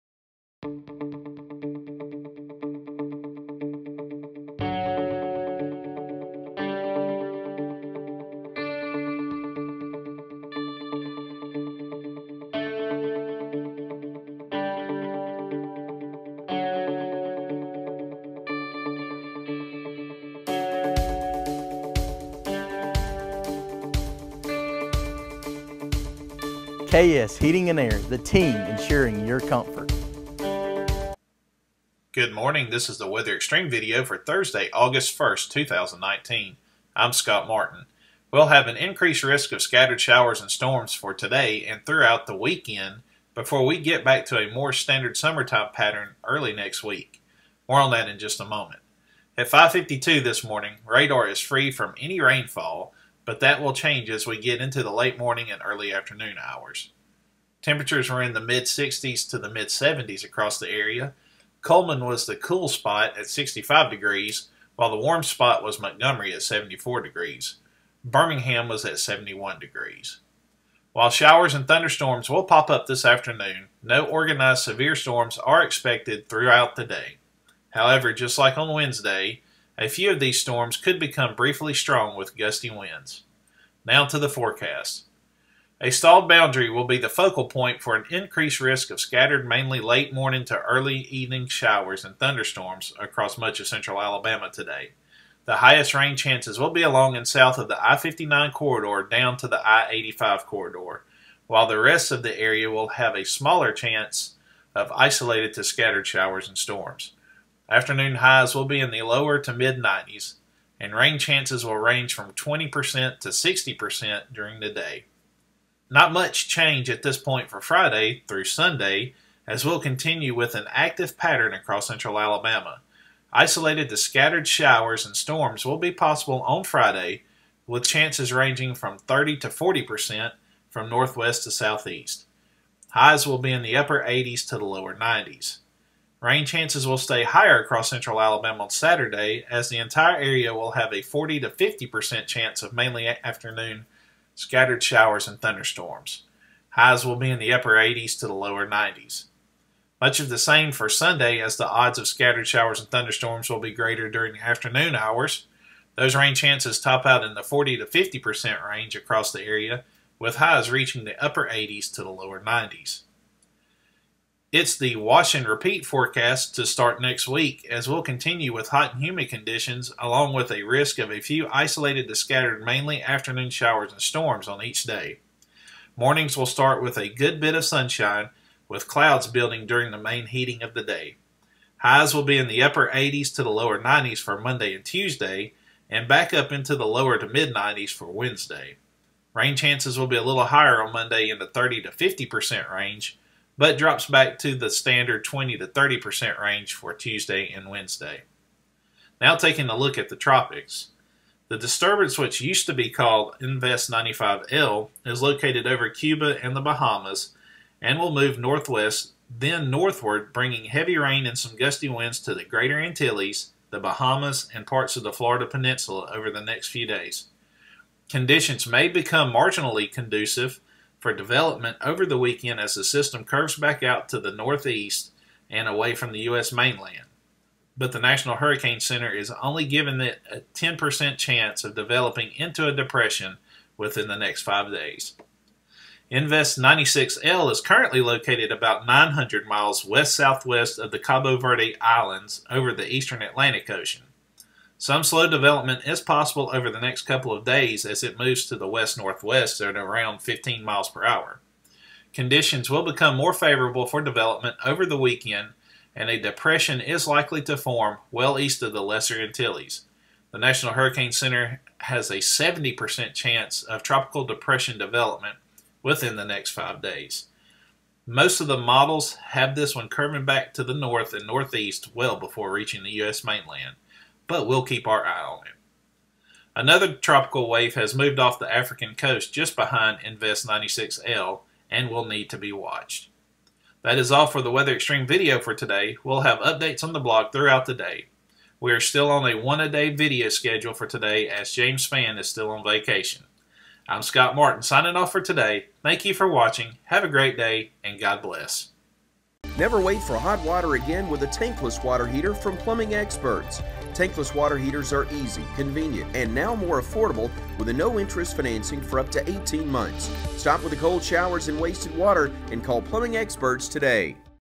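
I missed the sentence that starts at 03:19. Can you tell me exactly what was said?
Now taking a look at the tropics.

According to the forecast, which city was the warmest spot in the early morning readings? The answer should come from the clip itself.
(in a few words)
Montgomery.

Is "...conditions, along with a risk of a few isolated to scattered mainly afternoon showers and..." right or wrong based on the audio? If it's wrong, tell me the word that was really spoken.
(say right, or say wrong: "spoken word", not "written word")
right.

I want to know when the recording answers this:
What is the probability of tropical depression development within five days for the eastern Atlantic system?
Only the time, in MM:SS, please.
04:22.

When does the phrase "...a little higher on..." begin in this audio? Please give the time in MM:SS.
03:10.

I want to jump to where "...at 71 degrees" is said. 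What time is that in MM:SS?
01:08.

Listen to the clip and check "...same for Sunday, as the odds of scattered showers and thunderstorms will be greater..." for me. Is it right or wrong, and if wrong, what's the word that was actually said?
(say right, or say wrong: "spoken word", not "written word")
right.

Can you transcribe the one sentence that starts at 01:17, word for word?
However, just like on Wednesday, a few of these storms could become briefly strong with gusty winds.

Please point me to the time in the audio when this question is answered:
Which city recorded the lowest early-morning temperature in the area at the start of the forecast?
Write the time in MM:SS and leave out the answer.
01:01.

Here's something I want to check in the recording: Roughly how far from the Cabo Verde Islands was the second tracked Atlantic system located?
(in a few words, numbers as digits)
900 miles.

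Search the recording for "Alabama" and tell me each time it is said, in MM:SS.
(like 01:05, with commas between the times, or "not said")
01:34, 02:02, 02:18.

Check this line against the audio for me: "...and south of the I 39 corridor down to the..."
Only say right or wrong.
wrong.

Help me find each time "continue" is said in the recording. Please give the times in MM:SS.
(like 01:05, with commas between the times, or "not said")
01:59, 02:48.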